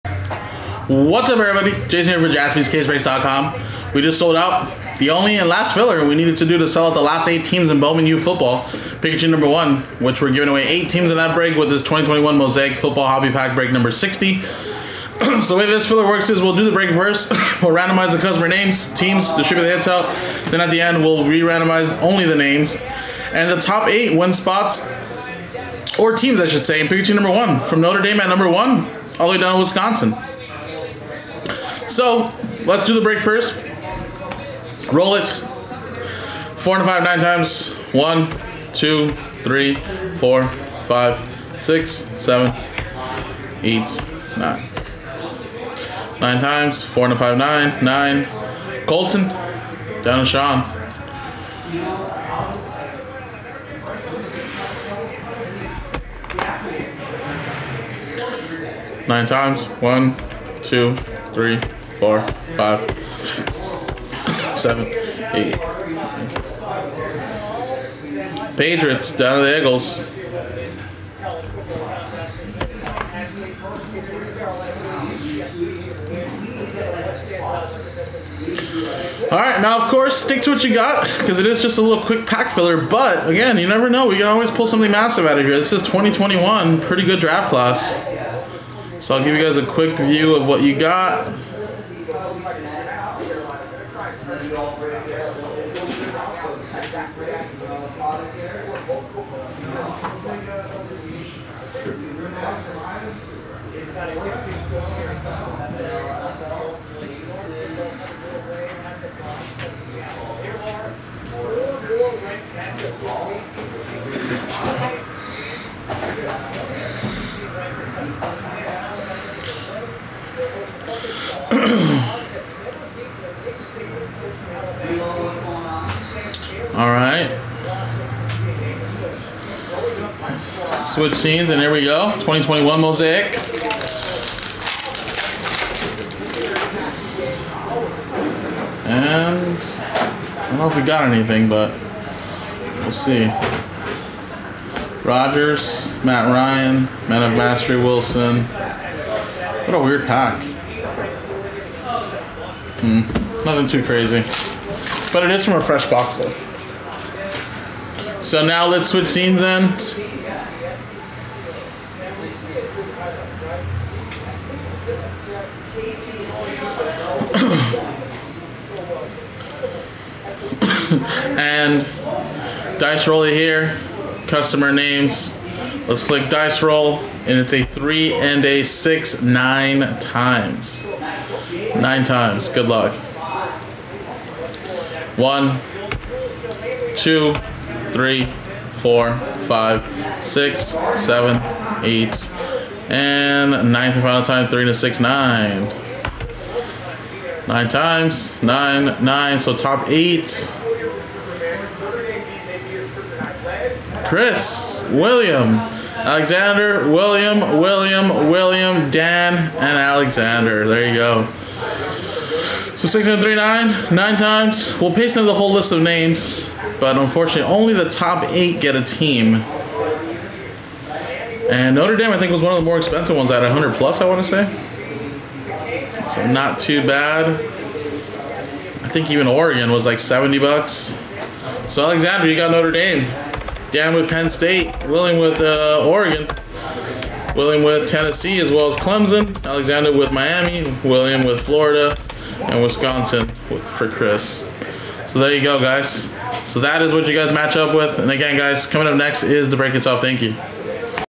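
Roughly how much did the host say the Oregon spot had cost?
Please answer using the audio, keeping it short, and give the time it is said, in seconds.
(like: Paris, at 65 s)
$70, at 229 s.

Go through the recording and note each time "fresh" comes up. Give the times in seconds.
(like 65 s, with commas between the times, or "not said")
155 s.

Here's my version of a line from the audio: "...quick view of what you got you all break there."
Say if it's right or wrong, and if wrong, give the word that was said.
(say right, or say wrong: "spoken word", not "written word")
right.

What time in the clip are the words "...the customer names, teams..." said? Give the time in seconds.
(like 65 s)
18 s.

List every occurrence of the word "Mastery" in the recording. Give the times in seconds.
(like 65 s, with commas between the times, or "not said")
147 s.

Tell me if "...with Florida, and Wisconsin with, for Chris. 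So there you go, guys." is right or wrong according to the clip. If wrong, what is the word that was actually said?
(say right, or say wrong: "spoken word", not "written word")
right.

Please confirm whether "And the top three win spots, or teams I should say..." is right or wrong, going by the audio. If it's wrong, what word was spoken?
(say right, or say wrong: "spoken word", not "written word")
wrong: "eight", not "three".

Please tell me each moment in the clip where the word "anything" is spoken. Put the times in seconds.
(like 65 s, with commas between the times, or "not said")
141 s.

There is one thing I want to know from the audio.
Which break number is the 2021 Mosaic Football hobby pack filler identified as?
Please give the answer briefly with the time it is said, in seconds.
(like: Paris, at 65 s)
60, at 13 s.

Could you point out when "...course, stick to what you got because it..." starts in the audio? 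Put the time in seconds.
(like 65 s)
79 s.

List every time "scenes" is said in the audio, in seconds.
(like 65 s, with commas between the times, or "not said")
131 s, 159 s.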